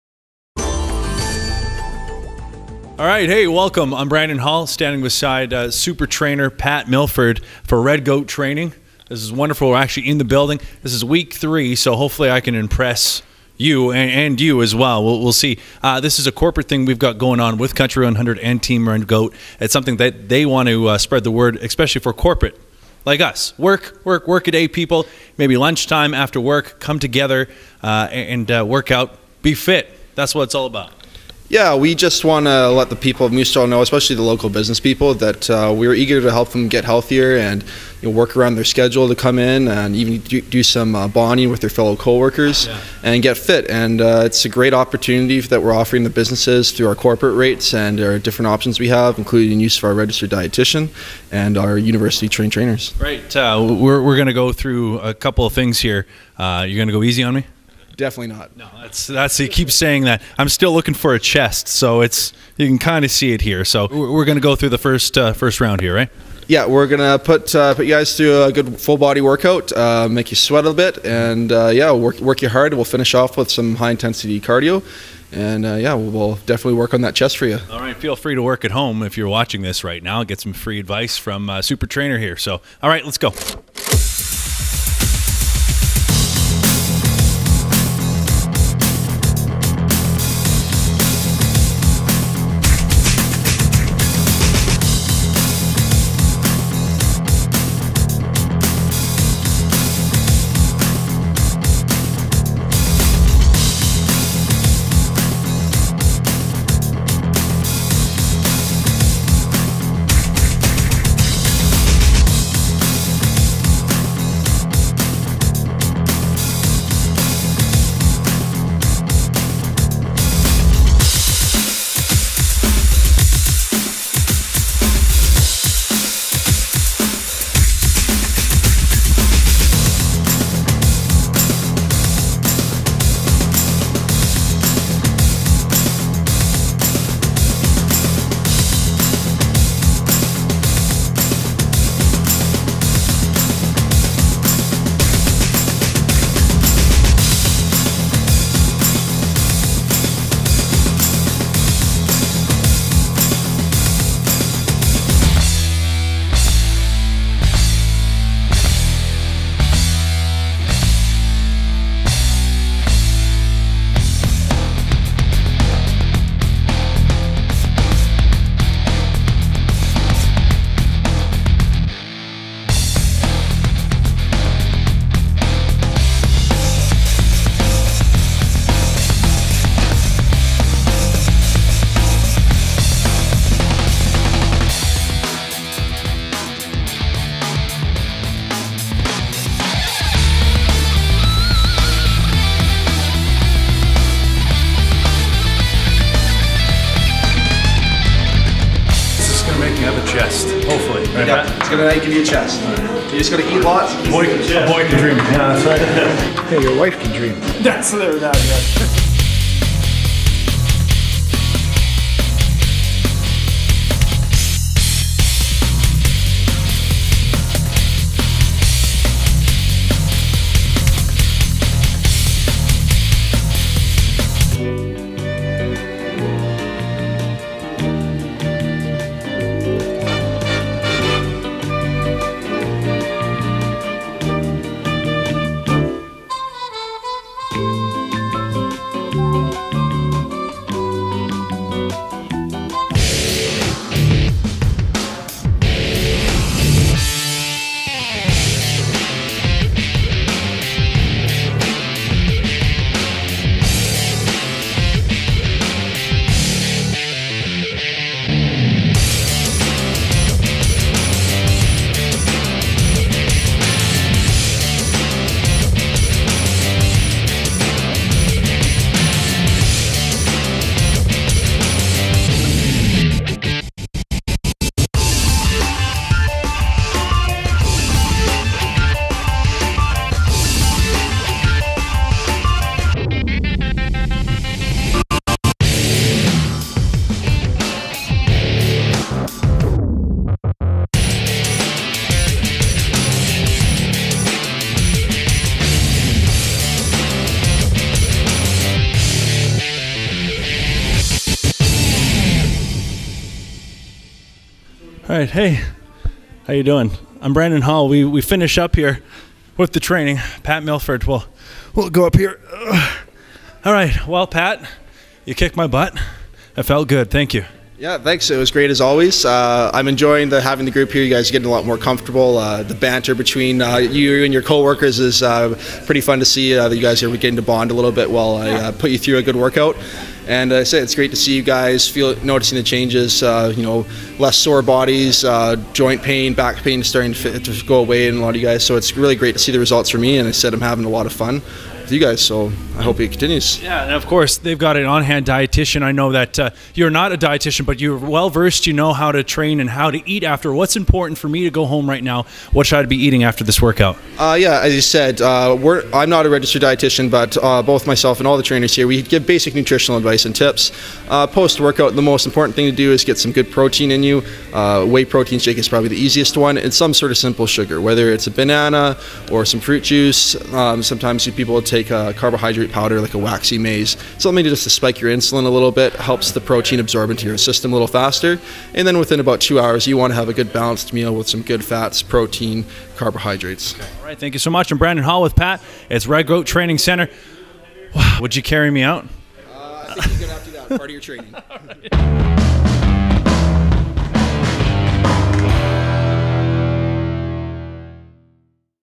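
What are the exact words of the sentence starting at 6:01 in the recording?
Uh, post-workout, the most important thing to do is get some good protein in you.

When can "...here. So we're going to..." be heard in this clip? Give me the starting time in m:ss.
1:03.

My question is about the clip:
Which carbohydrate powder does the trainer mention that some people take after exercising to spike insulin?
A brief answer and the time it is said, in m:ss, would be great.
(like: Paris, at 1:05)
waxy maize, at 6:13.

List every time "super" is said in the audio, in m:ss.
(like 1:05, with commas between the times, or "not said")
0:05, 1:21.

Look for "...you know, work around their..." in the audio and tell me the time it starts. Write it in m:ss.
0:38.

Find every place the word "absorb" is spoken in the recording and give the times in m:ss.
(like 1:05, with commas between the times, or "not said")
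6:16.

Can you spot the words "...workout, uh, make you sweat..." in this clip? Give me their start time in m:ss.
1:09.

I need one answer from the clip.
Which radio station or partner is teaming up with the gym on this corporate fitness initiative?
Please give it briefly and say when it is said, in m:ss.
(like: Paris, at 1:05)
Country 100, at 0:17.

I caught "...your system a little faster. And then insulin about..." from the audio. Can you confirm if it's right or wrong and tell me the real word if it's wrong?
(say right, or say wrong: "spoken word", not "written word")
wrong: "within", not "insulin".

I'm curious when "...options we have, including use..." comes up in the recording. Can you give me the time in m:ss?
0:48.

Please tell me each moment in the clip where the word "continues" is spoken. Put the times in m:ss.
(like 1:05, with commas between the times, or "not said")
5:43.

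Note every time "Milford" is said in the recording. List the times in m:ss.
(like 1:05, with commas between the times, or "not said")
0:06, 5:10.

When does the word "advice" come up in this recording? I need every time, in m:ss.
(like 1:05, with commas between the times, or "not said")
1:20, 5:59.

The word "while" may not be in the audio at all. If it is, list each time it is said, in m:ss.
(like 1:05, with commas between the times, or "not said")
5:28.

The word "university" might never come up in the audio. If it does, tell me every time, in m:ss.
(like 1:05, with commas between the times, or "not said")
0:51.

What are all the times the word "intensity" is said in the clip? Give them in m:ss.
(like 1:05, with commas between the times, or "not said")
1:13.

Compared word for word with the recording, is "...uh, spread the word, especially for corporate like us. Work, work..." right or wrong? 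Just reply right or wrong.
right.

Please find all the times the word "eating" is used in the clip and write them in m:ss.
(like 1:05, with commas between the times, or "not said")
5:52.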